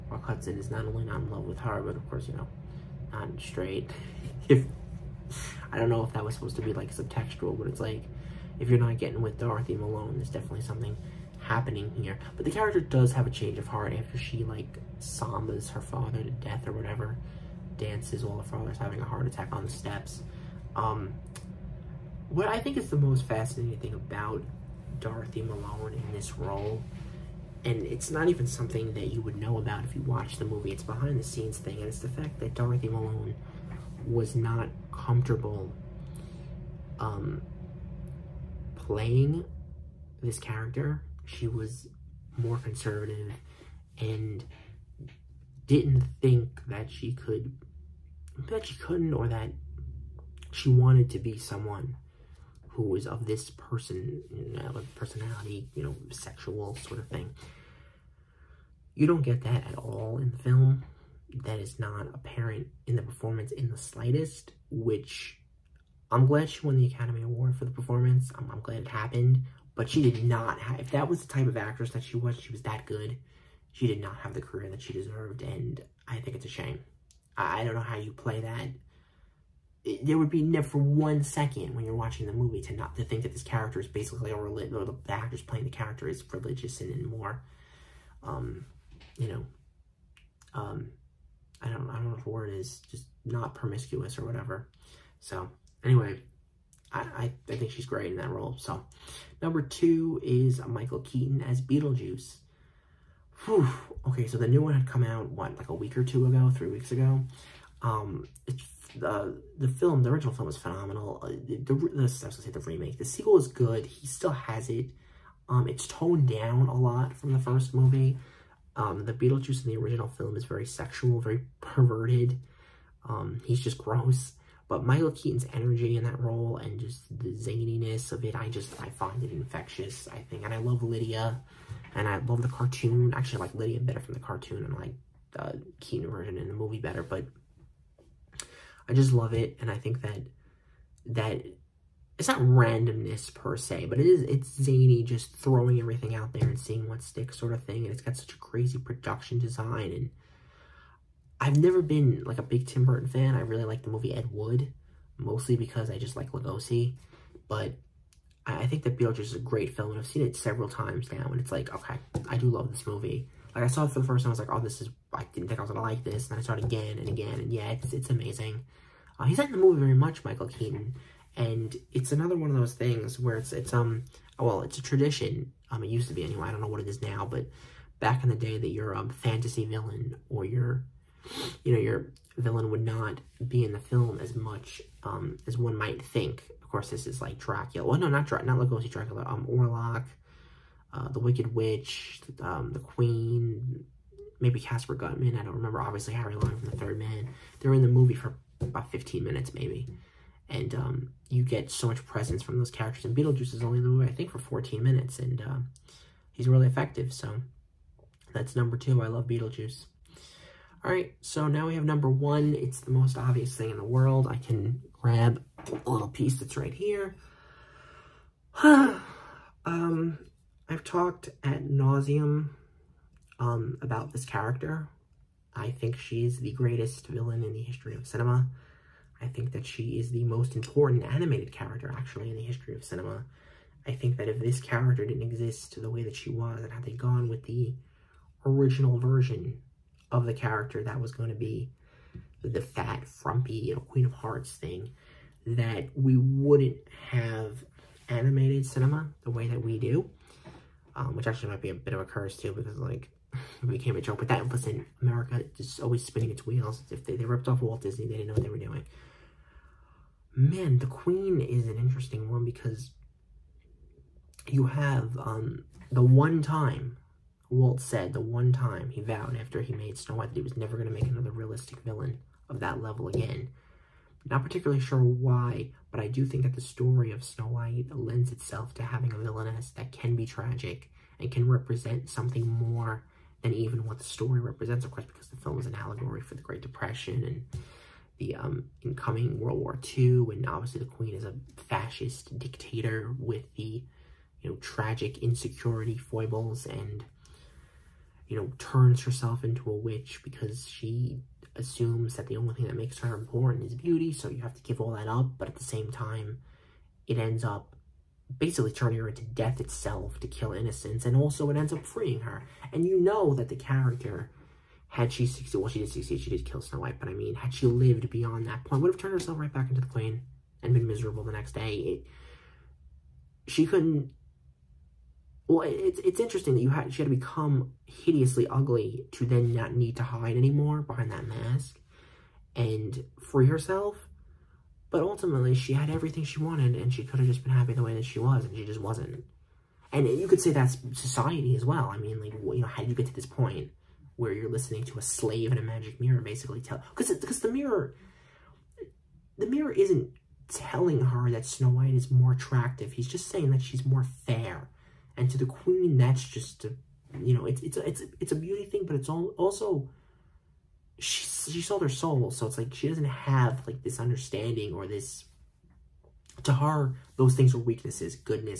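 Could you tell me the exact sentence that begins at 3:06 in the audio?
Of course, this is like Dracula.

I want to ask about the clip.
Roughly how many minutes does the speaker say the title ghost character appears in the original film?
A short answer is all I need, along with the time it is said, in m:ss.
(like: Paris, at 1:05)
14, at 3:24.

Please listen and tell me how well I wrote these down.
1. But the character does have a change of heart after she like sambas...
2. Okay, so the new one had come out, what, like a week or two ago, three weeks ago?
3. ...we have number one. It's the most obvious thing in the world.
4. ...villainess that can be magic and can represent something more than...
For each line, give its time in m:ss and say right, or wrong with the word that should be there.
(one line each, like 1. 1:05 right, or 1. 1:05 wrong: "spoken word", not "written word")
1. 0:12 right
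2. 1:44 right
3. 3:31 right
4. 4:39 wrong: "tragic", not "magic".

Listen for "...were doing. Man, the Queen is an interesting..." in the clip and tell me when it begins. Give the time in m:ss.
4:18.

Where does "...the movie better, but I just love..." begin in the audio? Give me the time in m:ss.
2:16.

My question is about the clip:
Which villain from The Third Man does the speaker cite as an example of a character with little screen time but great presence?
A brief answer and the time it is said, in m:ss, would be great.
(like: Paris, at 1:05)
Harry Long, at 3:16.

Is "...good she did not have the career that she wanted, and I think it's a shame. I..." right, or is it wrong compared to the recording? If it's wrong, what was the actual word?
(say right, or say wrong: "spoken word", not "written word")
wrong: "deserved", not "wanted".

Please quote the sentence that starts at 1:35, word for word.
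So anyway, I, I, I think she's great in that role.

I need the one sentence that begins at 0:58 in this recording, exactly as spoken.
You don't get that at all in the film.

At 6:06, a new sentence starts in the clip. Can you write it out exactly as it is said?
To her, those things are weaknesses.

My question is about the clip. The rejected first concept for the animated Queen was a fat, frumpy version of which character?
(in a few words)
Queen of Hearts.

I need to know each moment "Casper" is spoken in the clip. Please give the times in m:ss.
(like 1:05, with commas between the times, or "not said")
3:14.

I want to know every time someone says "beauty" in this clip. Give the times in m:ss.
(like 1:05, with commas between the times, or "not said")
5:03, 5:58.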